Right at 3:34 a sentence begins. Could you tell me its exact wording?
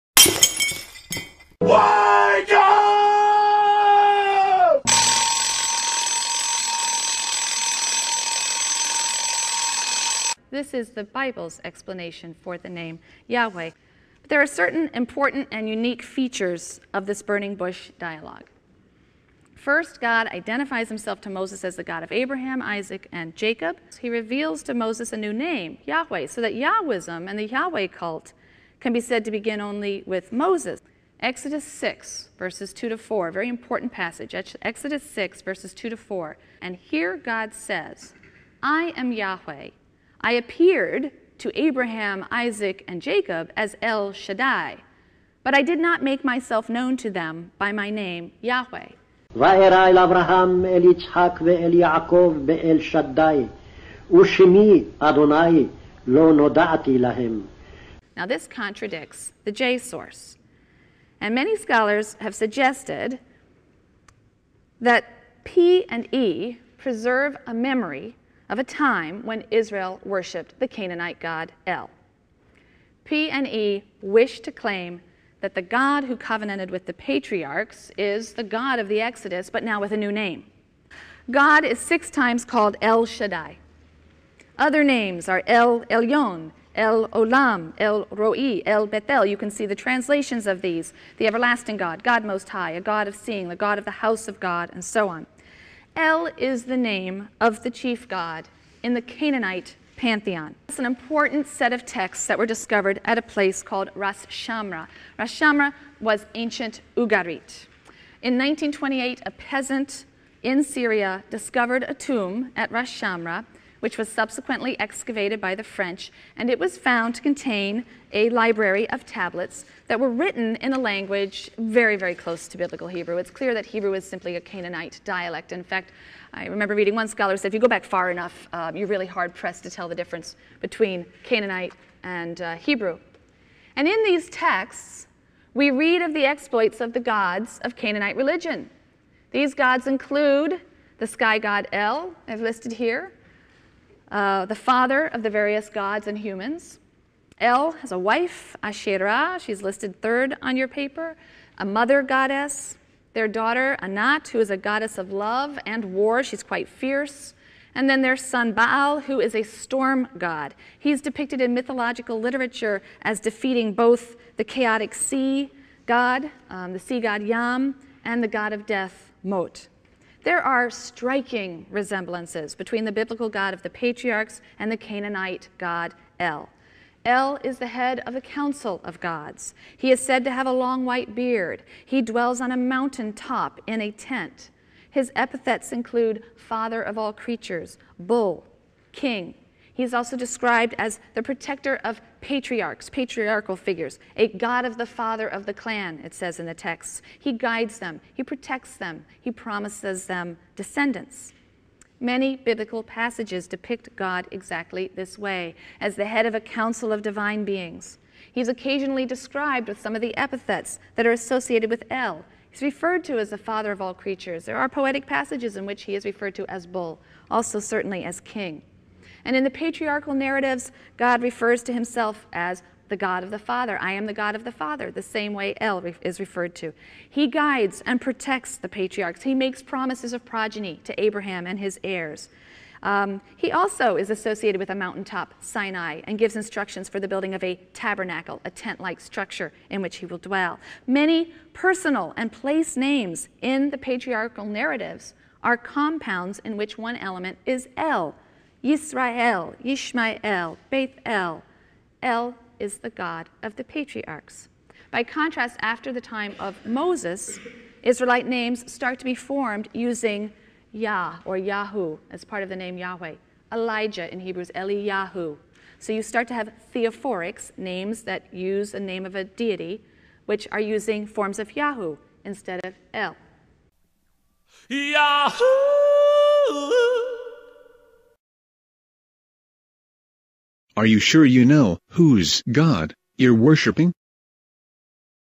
There are poetic passages in which he is referred to as bull, also certainly as king.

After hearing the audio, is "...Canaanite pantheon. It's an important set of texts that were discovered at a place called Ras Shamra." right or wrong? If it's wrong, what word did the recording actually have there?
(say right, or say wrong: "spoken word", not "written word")
right.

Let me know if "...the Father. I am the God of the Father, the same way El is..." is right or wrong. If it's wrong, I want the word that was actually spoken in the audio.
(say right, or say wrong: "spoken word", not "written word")
right.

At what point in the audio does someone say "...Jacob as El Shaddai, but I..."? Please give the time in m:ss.
0:43.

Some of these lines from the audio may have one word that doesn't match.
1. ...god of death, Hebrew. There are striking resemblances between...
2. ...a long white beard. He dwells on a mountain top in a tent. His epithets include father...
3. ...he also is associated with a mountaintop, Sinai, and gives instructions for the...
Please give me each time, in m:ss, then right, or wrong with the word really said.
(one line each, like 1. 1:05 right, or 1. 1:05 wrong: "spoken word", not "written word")
1. 2:48 wrong: "Mot", not "Hebrew"
2. 3:00 right
3. 3:53 right.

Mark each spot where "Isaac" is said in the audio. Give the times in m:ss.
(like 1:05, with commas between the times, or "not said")
0:22, 0:42.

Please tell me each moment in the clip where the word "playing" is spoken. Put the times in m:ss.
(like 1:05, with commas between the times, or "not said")
not said.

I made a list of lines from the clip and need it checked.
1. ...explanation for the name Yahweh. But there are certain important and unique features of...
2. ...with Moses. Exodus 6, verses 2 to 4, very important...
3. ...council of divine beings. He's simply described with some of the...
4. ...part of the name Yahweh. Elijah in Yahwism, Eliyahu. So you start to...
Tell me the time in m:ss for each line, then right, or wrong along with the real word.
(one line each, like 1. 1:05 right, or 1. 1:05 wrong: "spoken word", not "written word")
1. 0:11 right
2. 0:30 right
3. 3:26 wrong: "occasionally", not "simply"
4. 4:22 wrong: "Hebrews", not "Yahwism".